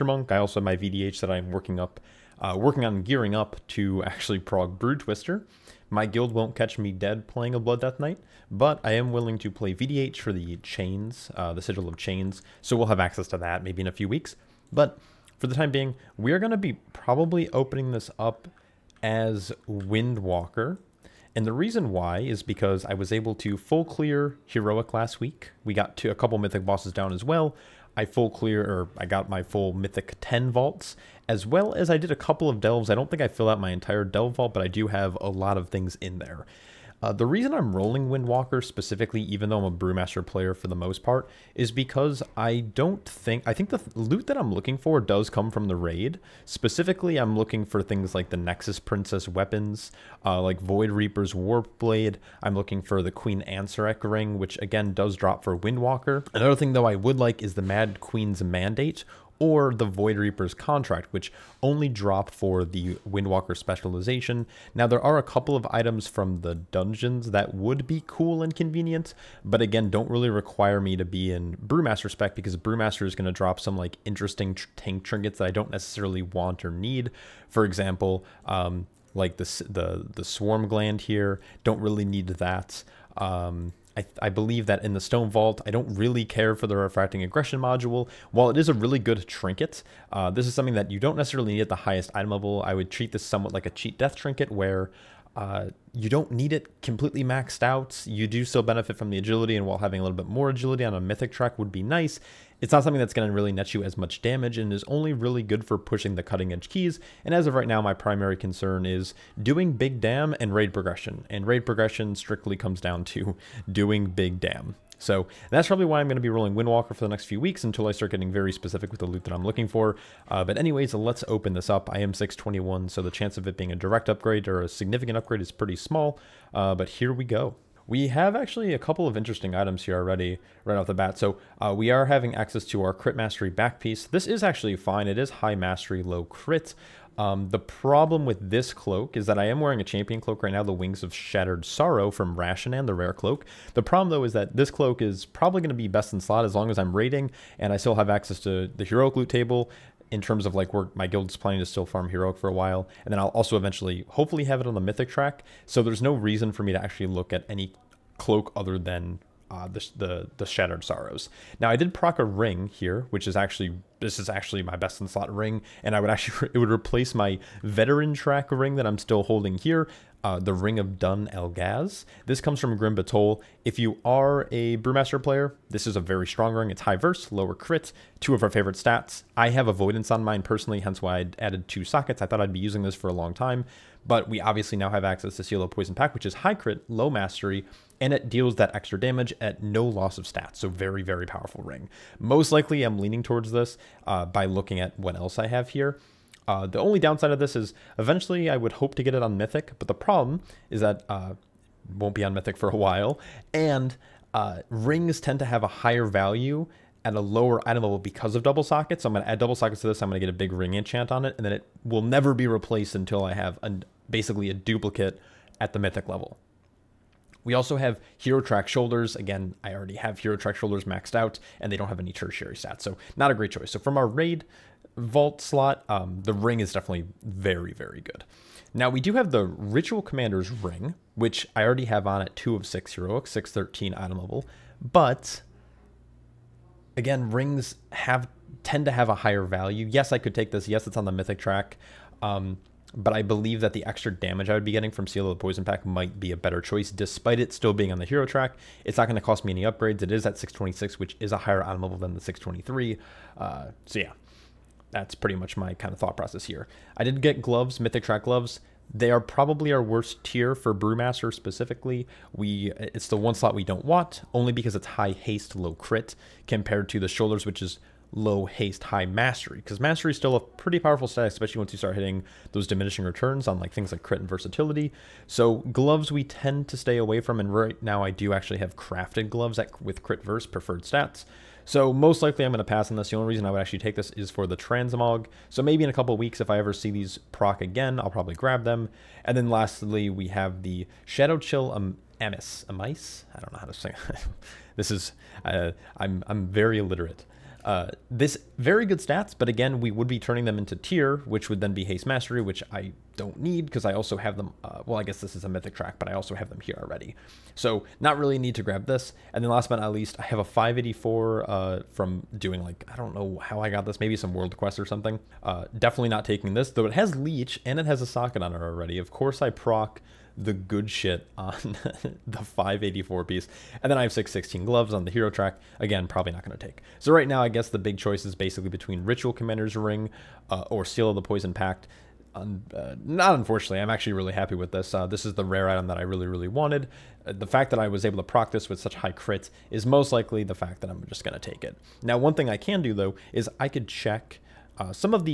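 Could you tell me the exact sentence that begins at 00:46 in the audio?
Specifically, I'm looking for things like the Nexus Princess weapons, uh, like Void Reaper's Warp Blade.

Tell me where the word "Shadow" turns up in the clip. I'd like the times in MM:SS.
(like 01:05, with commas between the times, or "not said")
04:51.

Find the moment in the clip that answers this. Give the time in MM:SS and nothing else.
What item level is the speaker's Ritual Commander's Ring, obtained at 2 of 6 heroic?
03:53.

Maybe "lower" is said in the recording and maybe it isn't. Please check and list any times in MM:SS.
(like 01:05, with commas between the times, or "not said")
02:57, 03:27.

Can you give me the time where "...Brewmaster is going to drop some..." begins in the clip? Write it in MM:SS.
01:12.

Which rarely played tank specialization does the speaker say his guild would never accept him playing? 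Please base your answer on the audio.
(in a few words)
Blood Death Knight.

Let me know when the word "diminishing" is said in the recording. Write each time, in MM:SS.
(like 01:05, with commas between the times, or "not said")
04:32.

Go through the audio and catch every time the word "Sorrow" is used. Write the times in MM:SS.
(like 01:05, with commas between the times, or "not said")
02:21, 02:40.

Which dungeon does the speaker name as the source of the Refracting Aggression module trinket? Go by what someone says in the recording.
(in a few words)
Stone Vault.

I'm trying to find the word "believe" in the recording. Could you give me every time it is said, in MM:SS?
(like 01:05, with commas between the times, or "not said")
01:24, 04:03.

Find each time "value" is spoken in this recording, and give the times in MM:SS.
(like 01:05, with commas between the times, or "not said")
03:26, 03:59.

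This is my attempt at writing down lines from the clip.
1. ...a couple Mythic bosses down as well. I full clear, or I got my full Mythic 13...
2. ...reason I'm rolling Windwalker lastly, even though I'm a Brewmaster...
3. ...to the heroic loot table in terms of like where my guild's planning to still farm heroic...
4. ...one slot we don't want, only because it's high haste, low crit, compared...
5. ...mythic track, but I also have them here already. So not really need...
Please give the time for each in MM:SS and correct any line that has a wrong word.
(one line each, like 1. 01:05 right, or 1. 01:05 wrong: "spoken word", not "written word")
1. 00:26 wrong: "10", not "13"
2. 00:37 wrong: "specifically", not "lastly"
3. 02:28 right
4. 04:23 right
5. 05:05 right.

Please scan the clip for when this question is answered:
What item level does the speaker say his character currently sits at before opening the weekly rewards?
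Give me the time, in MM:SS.
02:02.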